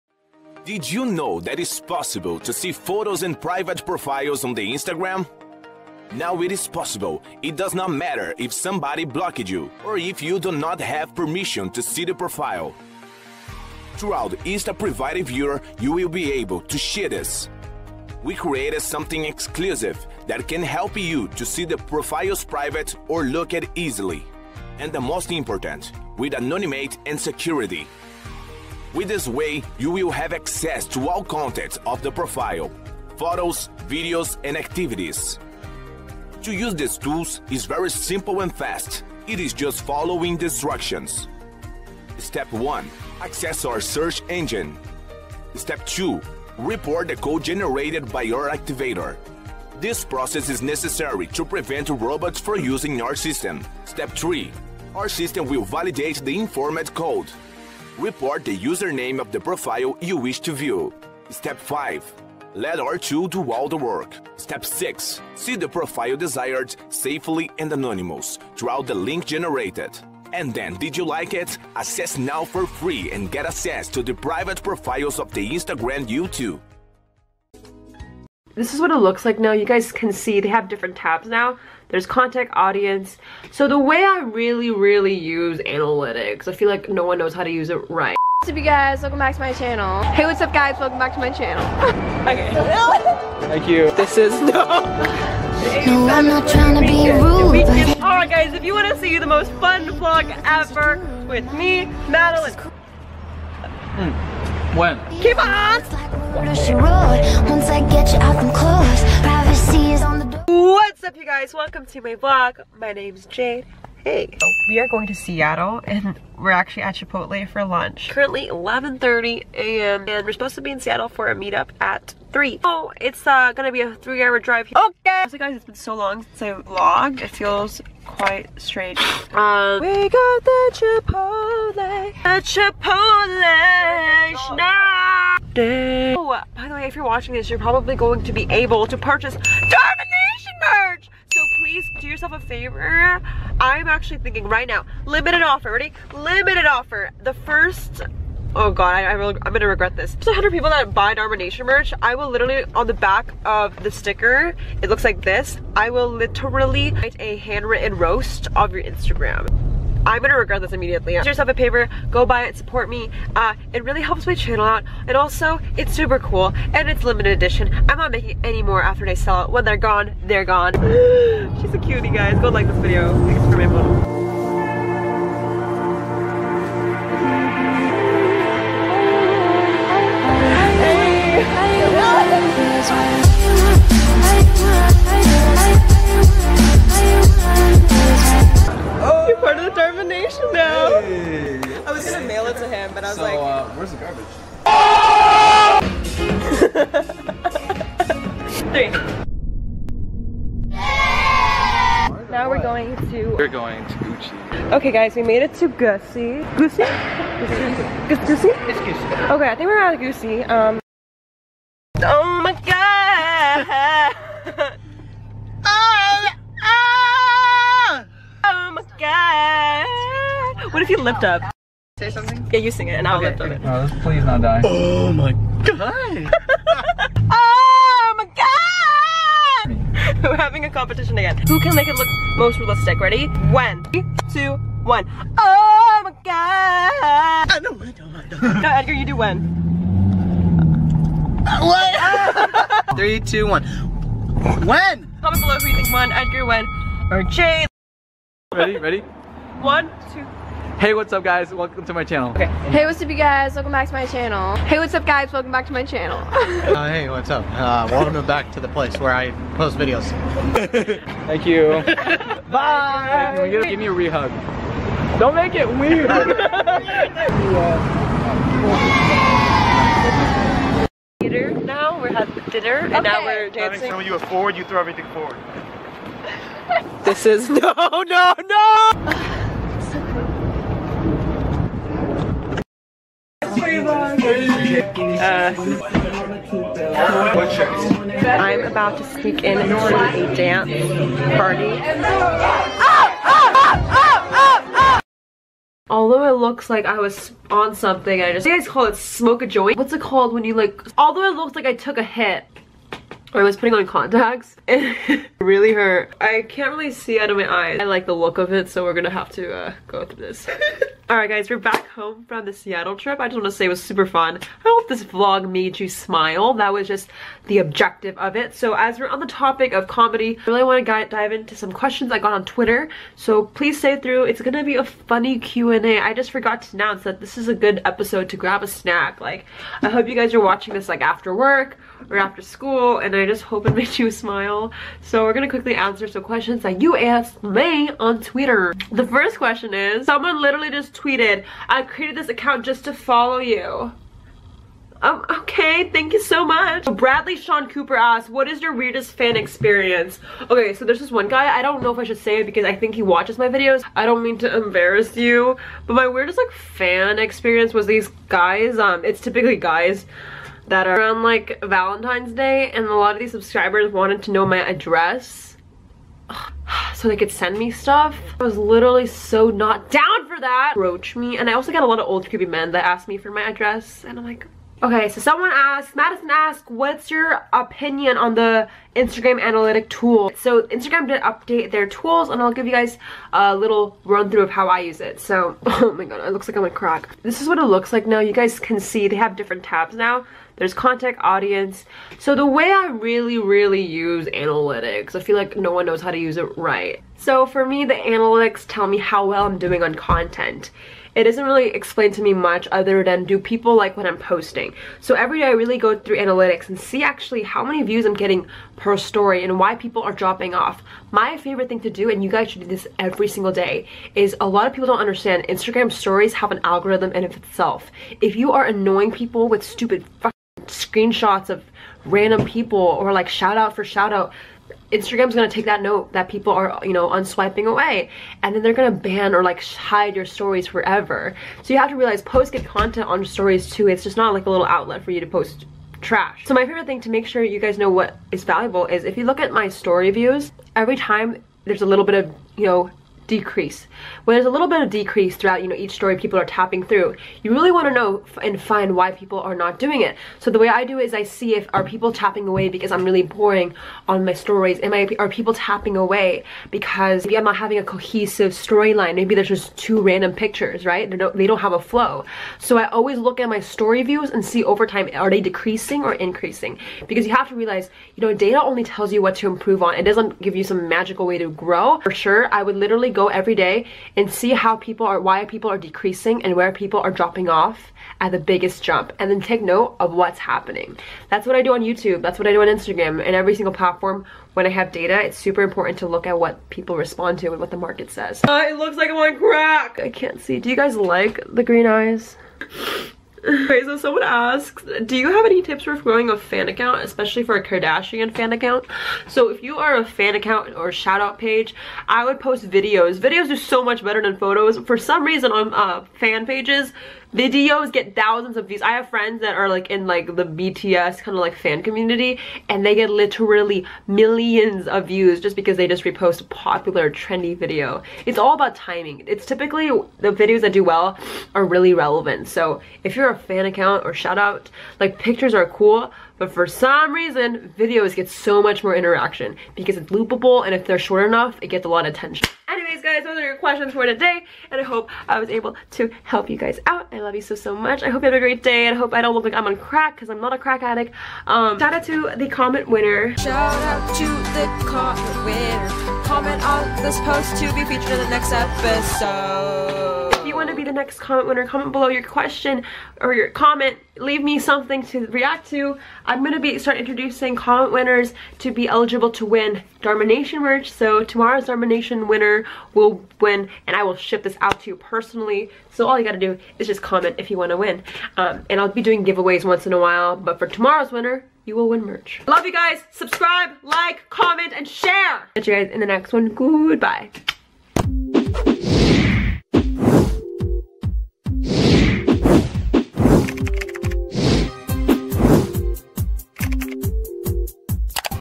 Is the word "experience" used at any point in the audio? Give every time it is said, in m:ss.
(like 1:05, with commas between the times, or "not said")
5:49, 5:57.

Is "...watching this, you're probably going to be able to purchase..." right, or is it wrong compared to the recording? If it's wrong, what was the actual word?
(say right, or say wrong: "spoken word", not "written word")
right.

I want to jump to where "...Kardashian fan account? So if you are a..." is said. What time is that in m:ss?
8:17.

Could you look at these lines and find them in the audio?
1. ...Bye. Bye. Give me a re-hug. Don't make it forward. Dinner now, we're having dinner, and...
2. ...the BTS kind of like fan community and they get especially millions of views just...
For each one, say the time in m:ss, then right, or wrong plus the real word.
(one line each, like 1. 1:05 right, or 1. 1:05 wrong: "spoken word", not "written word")
1. 4:22 wrong: "weird", not "forward"
2. 8:30 wrong: "literally", not "especially".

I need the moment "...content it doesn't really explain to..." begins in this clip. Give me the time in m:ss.
6:39.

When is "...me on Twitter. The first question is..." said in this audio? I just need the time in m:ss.
5:37.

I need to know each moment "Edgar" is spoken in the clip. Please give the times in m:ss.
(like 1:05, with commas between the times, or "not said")
3:58, 4:06.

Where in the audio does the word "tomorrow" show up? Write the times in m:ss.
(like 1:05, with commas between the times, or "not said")
9:21, 9:30.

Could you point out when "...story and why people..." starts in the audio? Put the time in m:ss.
6:48.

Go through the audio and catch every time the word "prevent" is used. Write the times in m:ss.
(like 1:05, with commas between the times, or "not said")
0:51.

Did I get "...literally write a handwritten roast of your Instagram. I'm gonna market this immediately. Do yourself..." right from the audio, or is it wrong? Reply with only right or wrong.
wrong.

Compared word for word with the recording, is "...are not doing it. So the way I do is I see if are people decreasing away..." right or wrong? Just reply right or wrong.
wrong.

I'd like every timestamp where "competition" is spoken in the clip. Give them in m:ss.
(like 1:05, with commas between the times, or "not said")
3:50.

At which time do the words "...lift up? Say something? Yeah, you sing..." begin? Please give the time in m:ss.
3:40.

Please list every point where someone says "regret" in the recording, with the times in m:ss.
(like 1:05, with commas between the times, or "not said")
2:29, 2:40.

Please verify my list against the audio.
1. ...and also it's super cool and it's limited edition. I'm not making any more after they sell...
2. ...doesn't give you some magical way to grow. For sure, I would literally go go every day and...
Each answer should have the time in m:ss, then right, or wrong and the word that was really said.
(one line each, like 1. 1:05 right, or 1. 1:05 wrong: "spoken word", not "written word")
1. 2:45 right
2. 7:50 right.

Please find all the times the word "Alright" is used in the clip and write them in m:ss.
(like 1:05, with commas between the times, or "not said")
1:38, 5:11.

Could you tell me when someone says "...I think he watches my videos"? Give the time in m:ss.
5:52.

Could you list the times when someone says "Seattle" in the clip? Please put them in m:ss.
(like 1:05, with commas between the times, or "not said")
1:55, 2:00, 5:12.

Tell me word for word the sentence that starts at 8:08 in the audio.
Uh, it looks like I'm on crack!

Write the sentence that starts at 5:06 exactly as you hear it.
I can't really see out of my eyes.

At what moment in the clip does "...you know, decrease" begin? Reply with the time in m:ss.
7:22.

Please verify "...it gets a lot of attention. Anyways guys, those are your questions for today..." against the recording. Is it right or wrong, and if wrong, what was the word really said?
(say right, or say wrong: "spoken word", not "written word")
right.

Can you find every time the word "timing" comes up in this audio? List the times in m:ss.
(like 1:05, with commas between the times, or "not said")
8:38.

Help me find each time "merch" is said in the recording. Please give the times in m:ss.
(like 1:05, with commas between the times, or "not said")
2:20, 2:31, 9:20, 9:32.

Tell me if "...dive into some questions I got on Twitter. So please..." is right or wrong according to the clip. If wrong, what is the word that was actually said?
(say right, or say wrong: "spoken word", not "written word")
right.